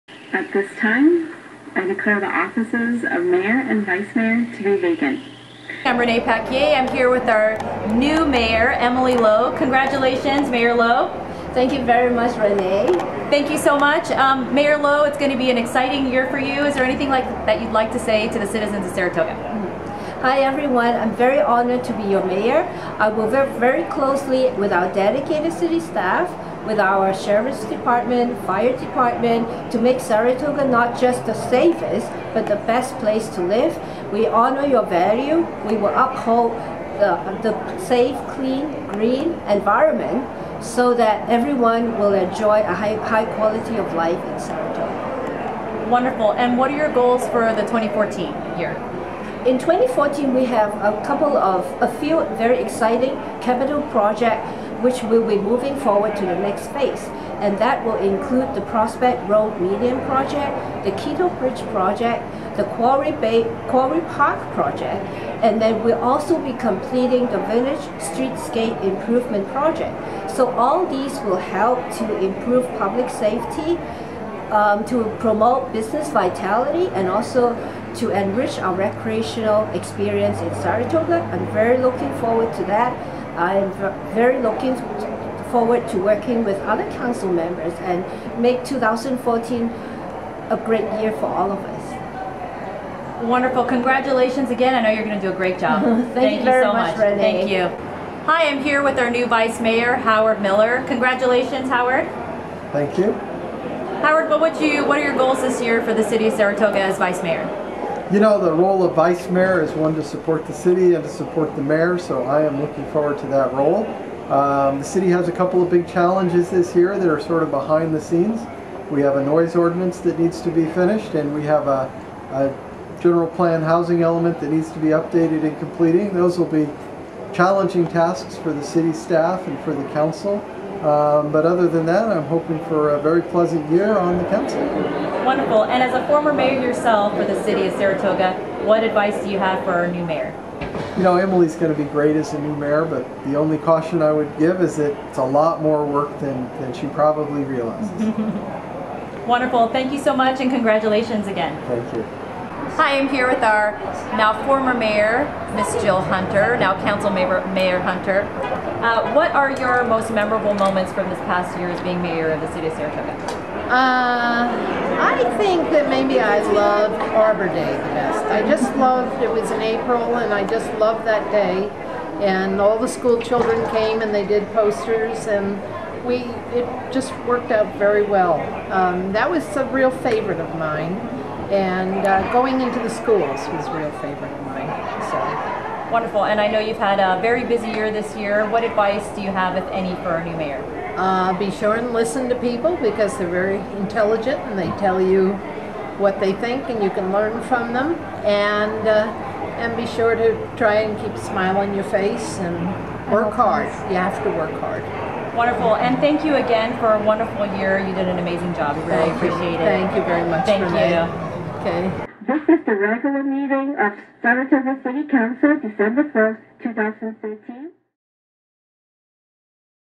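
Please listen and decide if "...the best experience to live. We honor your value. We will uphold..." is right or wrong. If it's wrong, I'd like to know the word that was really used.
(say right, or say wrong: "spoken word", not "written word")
wrong: "place", not "experience".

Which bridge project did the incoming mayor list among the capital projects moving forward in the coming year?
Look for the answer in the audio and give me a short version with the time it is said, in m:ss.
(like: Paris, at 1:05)
Quito Bridge Project, at 1:01.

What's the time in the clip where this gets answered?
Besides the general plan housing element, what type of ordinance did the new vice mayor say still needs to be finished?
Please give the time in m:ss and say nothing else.
1:59.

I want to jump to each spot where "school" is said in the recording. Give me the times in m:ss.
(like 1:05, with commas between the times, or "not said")
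2:52, 3:02.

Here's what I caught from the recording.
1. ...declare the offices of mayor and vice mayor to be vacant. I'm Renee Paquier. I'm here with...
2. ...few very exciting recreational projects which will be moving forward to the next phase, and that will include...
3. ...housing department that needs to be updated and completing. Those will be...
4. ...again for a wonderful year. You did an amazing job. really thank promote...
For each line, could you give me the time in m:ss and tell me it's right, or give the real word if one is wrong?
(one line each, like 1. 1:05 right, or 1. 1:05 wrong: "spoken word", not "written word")
1. 0:01 right
2. 0:51 wrong: "capital", not "recreational"
3. 2:03 wrong: "element", not "department"
4. 3:26 wrong: "appreciate", not "promote".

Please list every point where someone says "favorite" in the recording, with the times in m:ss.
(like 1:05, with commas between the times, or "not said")
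2:59, 3:03.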